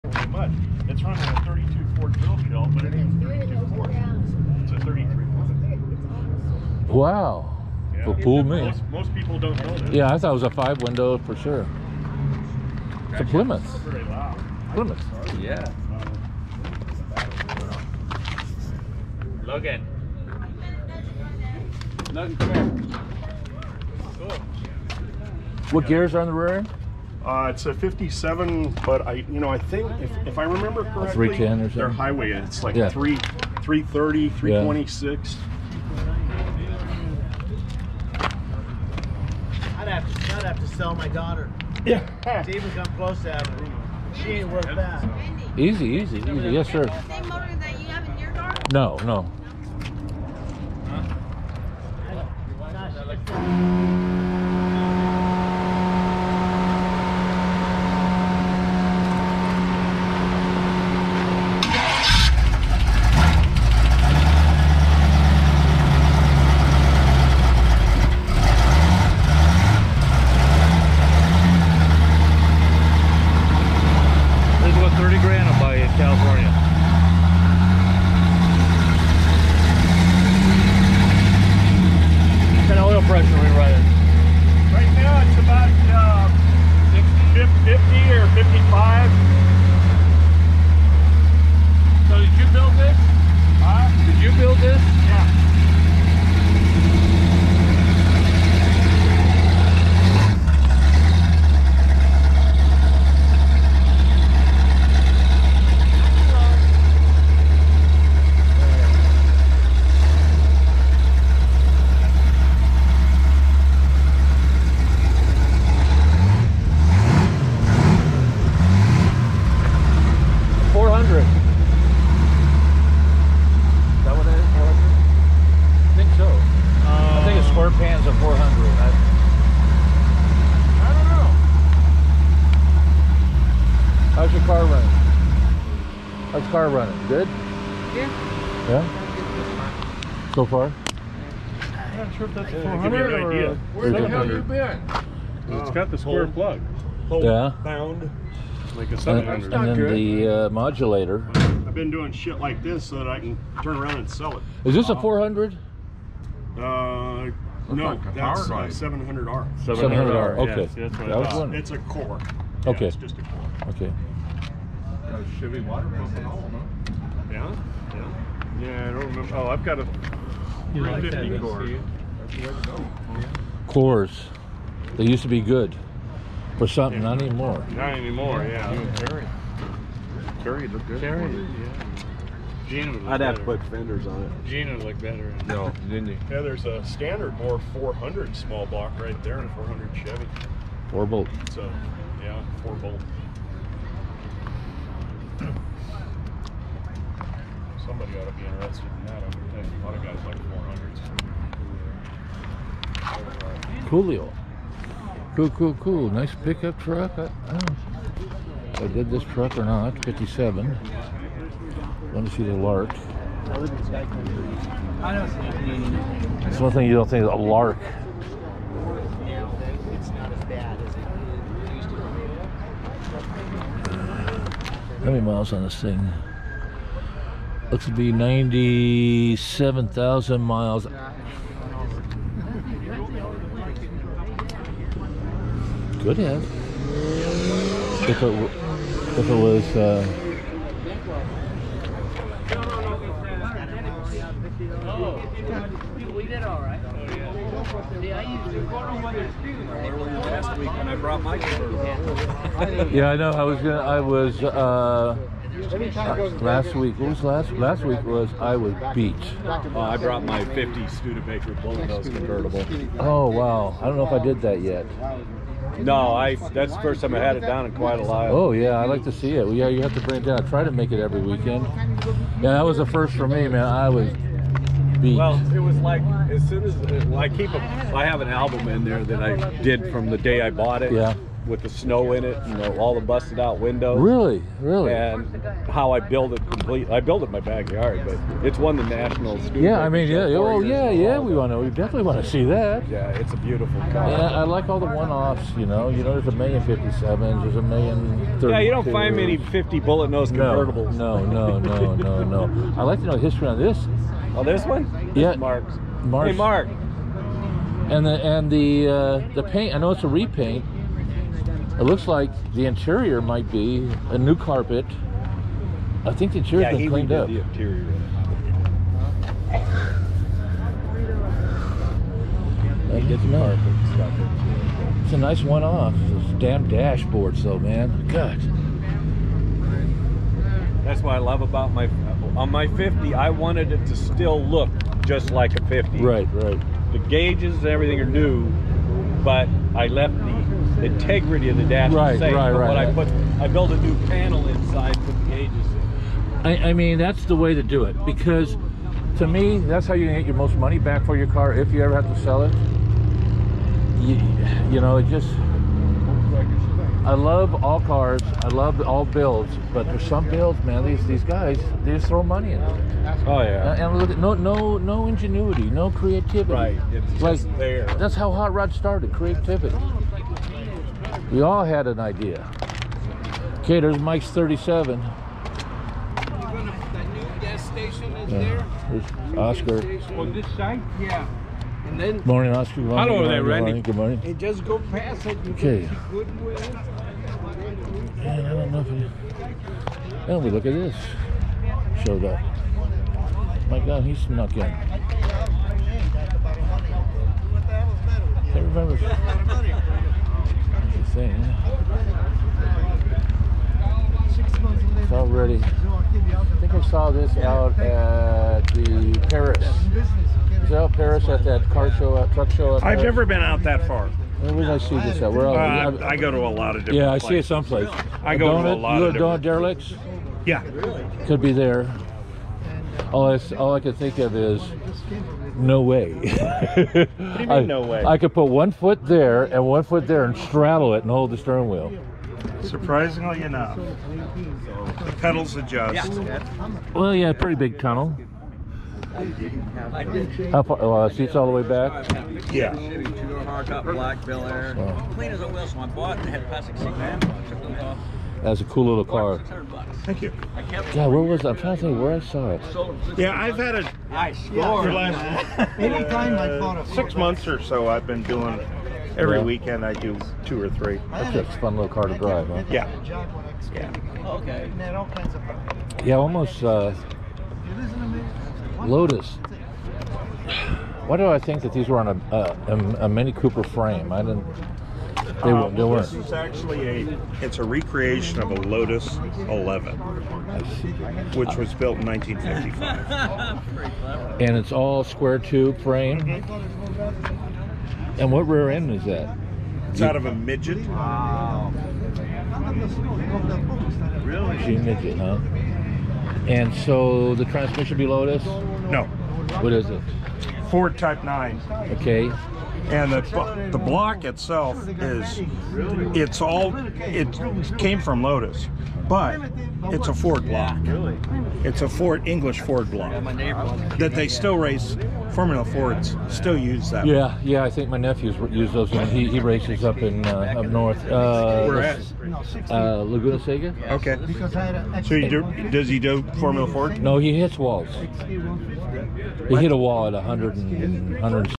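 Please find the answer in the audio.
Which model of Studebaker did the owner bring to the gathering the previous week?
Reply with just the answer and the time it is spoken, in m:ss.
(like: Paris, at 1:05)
'50 convertible, at 4:20.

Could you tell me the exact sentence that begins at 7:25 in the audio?
I bought and had plastic seat man.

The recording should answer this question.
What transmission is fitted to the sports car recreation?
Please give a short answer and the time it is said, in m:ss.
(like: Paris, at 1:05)
Ford Type 9, at 8:20.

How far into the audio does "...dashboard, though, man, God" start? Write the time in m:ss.
5:26.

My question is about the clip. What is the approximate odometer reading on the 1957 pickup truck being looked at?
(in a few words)
97,000 miles.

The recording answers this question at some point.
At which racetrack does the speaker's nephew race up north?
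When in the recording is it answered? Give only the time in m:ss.
8:43.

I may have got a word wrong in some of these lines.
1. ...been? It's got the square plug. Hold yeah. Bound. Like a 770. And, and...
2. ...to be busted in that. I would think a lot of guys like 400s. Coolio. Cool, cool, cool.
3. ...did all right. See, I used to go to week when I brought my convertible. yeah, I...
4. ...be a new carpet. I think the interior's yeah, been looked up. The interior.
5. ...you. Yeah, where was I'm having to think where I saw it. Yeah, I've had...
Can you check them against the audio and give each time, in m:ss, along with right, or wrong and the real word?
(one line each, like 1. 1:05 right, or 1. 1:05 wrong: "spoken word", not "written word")
1. 2:24 wrong: "700", not "770"
2. 3:18 wrong: "interested", not "busted"
3. 4:06 right
4. 5:13 wrong: "cleaned", not "looked"
5. 7:30 wrong: "trying", not "having".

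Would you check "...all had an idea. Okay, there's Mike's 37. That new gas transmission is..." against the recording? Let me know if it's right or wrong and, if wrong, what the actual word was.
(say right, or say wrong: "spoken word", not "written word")
wrong: "station", not "transmission".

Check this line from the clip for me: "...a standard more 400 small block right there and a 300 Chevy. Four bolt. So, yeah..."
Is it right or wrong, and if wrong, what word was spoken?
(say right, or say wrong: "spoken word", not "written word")
wrong: "400", not "300".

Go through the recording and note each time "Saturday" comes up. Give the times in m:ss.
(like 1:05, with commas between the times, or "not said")
not said.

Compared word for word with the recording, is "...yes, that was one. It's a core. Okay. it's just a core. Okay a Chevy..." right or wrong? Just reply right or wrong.
right.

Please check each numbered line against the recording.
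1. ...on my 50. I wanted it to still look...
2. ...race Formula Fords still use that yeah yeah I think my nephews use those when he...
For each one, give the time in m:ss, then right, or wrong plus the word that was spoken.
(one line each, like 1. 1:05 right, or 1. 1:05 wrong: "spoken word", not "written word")
1. 5:32 right
2. 8:34 right.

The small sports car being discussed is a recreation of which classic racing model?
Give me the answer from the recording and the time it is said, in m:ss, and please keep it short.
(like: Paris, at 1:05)
Lotus 11, at 7:58.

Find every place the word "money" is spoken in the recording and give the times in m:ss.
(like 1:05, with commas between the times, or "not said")
5:50, 6:02.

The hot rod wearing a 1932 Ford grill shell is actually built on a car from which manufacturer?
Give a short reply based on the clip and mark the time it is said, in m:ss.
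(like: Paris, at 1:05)
Plymouth, at 0:13.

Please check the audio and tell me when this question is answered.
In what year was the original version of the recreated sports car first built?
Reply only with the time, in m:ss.
8:02.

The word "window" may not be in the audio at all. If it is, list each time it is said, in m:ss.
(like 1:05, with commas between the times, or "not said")
0:10, 4:43.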